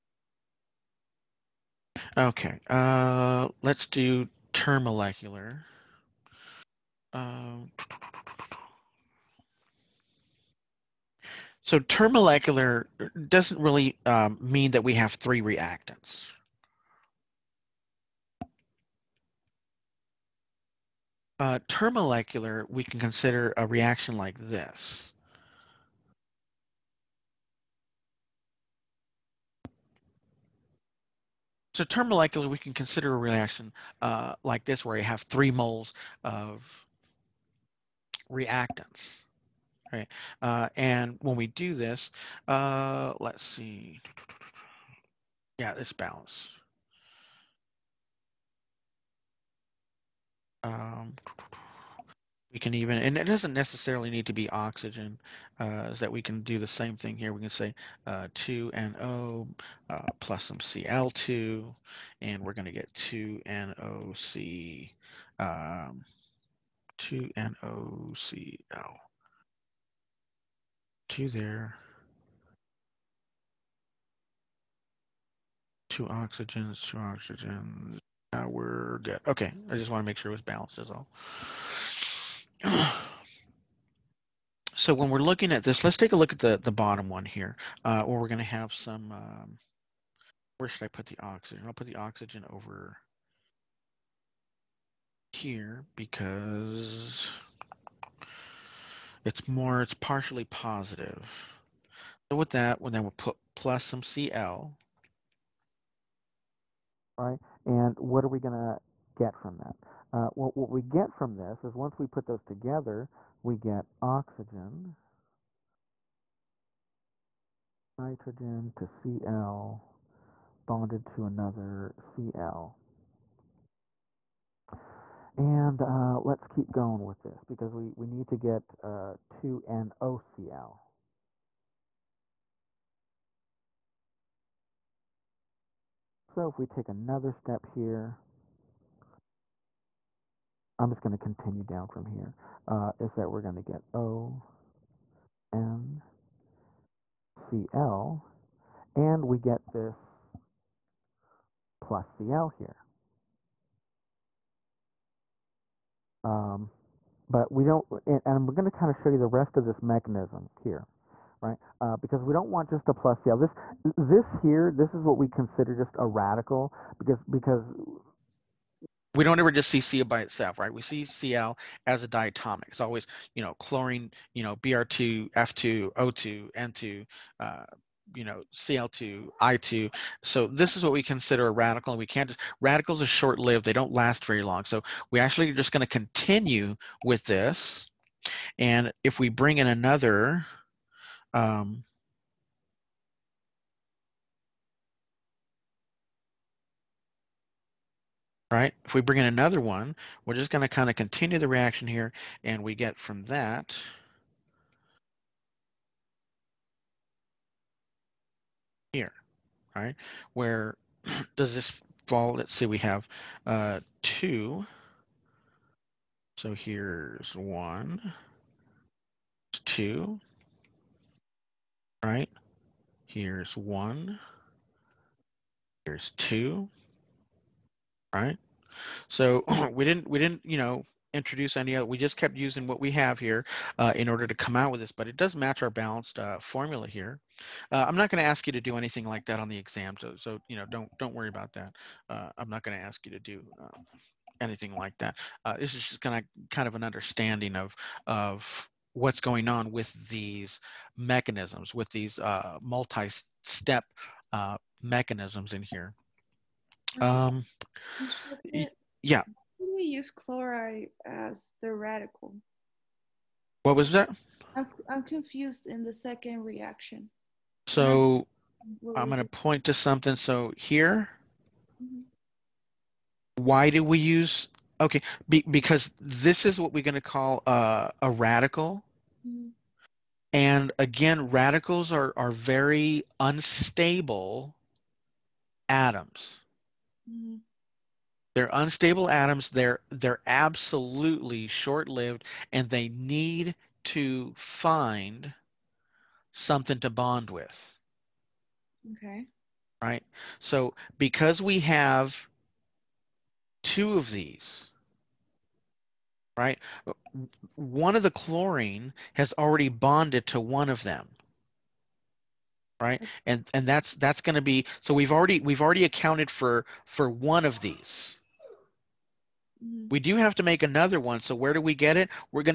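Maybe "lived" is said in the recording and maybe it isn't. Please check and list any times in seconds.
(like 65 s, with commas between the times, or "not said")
183 s, 291 s.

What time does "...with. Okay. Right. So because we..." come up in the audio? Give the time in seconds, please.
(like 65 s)
297 s.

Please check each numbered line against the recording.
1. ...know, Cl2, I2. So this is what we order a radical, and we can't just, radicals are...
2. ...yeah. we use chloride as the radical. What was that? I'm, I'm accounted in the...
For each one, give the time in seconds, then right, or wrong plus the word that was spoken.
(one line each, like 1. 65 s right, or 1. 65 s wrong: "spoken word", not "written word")
1. 178 s wrong: "consider", not "order"
2. 259 s wrong: "confused", not "accounted".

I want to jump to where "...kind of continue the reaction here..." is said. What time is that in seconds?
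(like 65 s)
200 s.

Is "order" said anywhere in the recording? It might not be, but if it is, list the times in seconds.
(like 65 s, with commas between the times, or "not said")
234 s.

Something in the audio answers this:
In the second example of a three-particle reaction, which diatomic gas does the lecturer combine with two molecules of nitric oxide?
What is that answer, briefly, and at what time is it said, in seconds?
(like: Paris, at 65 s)
Cl2, at 60 s.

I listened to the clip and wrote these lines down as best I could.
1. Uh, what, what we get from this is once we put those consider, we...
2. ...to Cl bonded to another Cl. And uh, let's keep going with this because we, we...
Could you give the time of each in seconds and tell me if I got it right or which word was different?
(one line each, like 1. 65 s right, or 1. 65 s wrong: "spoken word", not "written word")
1. 110 s wrong: "together", not "consider"
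2. 118 s right.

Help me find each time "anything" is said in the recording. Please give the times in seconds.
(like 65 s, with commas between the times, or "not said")
238 s, 244 s.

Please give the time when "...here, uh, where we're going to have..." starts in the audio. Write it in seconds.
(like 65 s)
87 s.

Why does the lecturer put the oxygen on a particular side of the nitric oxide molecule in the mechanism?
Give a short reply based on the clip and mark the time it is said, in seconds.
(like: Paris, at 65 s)
partially positive, at 99 s.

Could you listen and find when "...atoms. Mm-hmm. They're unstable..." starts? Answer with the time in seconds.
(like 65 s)
285 s.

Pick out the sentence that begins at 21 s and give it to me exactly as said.
Uh, termolecular, we can consider a reaction like this.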